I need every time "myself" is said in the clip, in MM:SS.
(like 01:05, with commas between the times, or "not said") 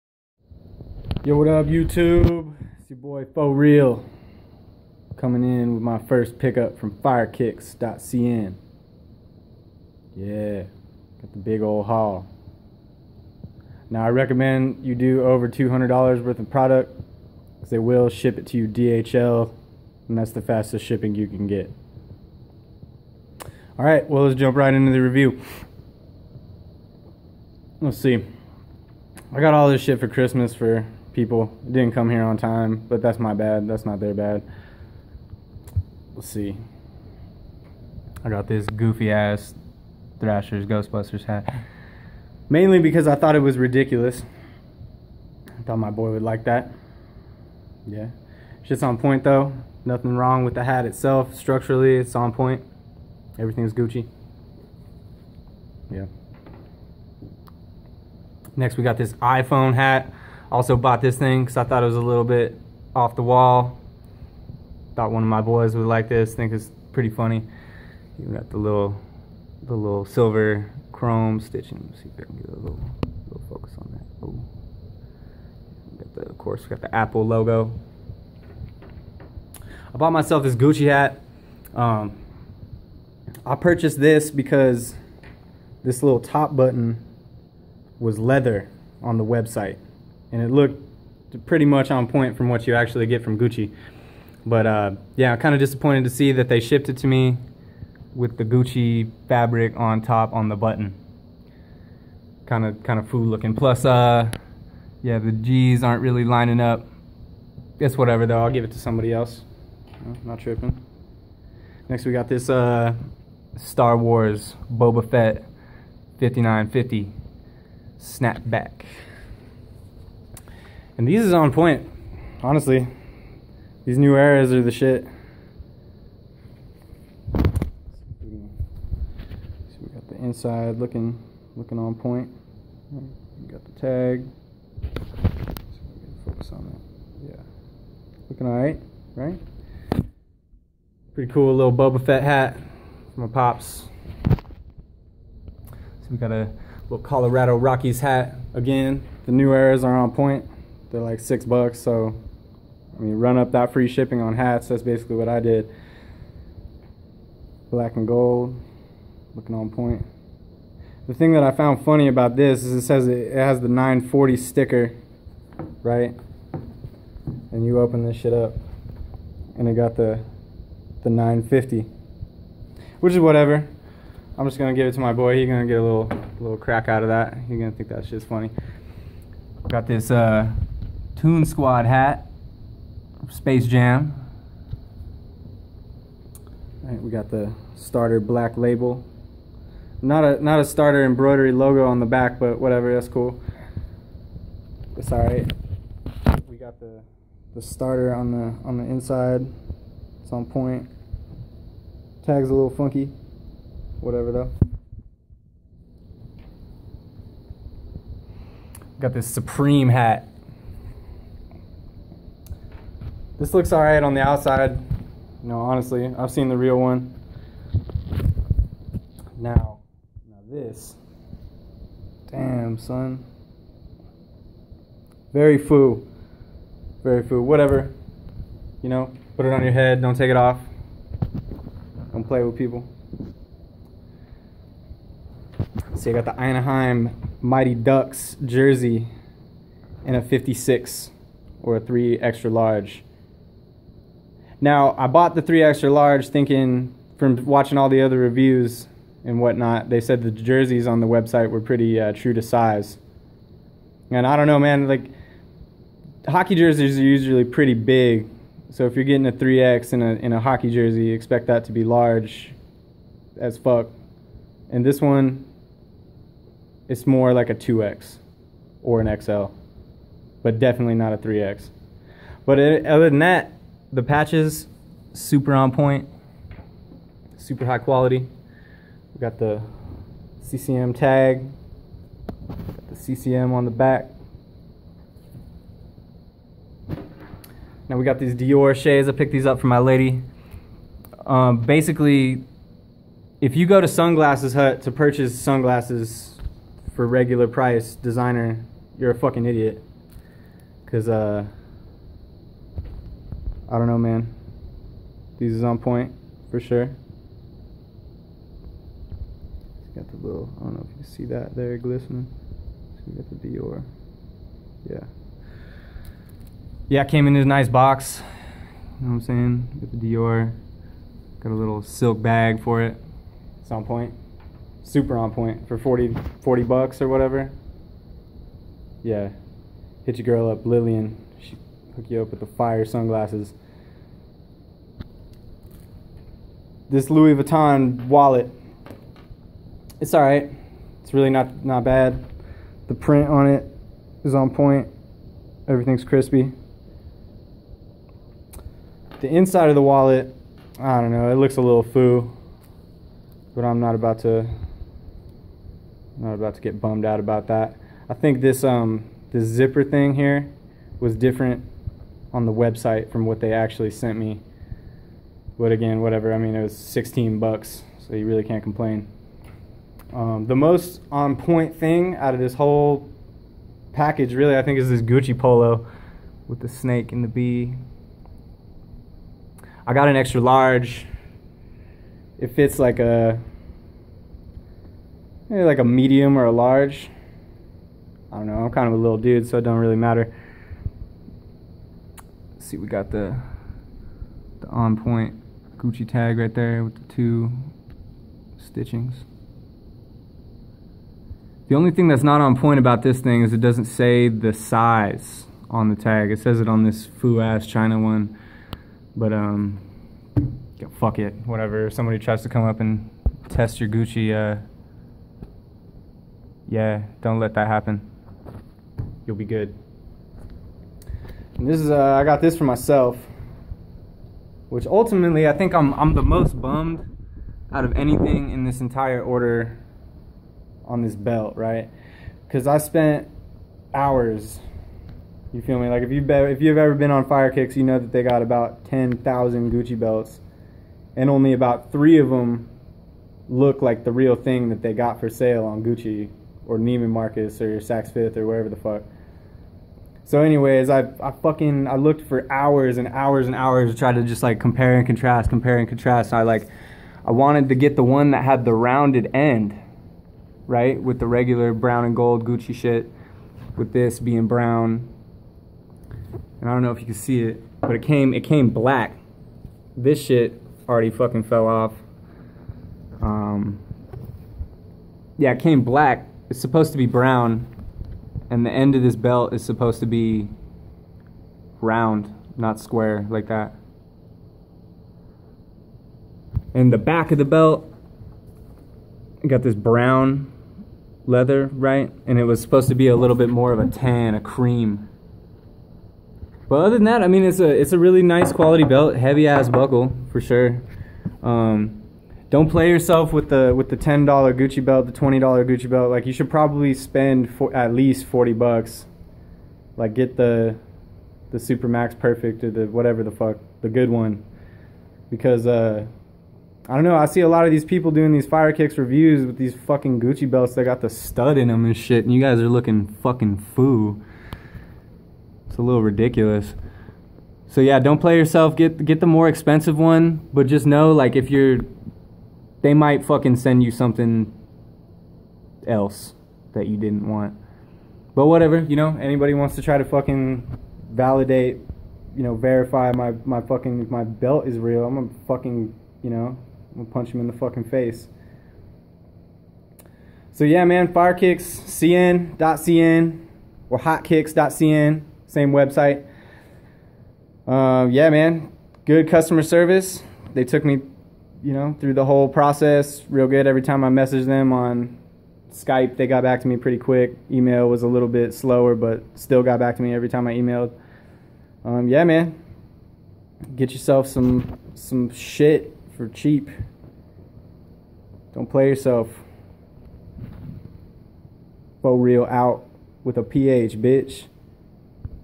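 01:20, 07:02.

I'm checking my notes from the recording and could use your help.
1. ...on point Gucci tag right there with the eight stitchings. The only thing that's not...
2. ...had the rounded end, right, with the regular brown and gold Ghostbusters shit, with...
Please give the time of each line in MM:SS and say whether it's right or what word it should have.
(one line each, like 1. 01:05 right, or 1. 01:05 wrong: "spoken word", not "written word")
1. 06:34 wrong: "two", not "eight"
2. 07:38 wrong: "Gucci", not "Ghostbusters".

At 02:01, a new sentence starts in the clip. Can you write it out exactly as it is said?
And these is on point, honestly.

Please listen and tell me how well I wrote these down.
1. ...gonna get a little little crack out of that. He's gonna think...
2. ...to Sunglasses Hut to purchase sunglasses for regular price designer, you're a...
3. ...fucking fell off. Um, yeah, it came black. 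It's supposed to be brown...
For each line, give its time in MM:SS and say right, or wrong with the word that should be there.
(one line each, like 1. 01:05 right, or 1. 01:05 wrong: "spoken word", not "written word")
1. 02:55 right
2. 04:53 right
3. 07:51 right.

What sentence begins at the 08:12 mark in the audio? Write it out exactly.
And it was supposed to be a little bit more of a tan, a cream.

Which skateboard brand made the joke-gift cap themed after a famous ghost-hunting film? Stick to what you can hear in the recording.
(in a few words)
Thrasher.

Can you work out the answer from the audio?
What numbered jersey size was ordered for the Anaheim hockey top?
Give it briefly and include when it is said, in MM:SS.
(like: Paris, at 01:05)
56, at 04:00.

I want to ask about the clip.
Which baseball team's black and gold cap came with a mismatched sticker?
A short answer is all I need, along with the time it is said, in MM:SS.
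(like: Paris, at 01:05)
Colorado Rockies, at 02:27.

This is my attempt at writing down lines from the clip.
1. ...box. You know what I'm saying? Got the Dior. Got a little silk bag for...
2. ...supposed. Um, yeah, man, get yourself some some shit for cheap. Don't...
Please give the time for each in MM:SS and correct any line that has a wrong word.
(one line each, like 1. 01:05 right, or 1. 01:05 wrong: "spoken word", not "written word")
1. 05:17 right
2. 09:30 wrong: "emailed", not "supposed".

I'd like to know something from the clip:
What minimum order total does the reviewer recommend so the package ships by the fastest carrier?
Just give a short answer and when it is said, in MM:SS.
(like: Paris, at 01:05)
$200, at 00:15.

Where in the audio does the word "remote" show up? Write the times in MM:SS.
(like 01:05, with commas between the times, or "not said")
not said.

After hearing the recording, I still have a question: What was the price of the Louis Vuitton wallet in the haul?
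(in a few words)
$16.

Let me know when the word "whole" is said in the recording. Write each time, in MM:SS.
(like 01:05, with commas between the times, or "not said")
06:12, 09:22.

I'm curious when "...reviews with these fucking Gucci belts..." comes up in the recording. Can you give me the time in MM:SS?
08:38.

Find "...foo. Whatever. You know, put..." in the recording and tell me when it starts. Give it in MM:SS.
03:47.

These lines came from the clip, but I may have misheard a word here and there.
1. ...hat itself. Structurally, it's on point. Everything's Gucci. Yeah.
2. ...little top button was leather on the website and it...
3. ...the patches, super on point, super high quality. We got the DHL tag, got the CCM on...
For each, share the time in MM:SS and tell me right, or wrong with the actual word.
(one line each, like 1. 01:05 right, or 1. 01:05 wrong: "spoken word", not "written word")
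1. 00:50 right
2. 01:26 right
3. 04:33 wrong: "CCM", not "DHL".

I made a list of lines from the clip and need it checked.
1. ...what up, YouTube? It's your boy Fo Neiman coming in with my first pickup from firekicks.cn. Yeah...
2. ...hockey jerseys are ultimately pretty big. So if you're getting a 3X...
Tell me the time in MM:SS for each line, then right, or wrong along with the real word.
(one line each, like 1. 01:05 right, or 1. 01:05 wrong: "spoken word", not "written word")
1. 00:01 wrong: "Real", not "Neiman"
2. 04:16 wrong: "usually", not "ultimately".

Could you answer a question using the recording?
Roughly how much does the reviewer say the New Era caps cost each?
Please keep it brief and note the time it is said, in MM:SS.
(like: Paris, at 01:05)
$6, at 02:31.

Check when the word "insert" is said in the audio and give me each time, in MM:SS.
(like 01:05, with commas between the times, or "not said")
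not said.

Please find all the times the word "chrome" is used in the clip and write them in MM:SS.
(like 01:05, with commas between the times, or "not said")
01:10.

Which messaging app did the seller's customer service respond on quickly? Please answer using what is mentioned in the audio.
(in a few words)
Skype.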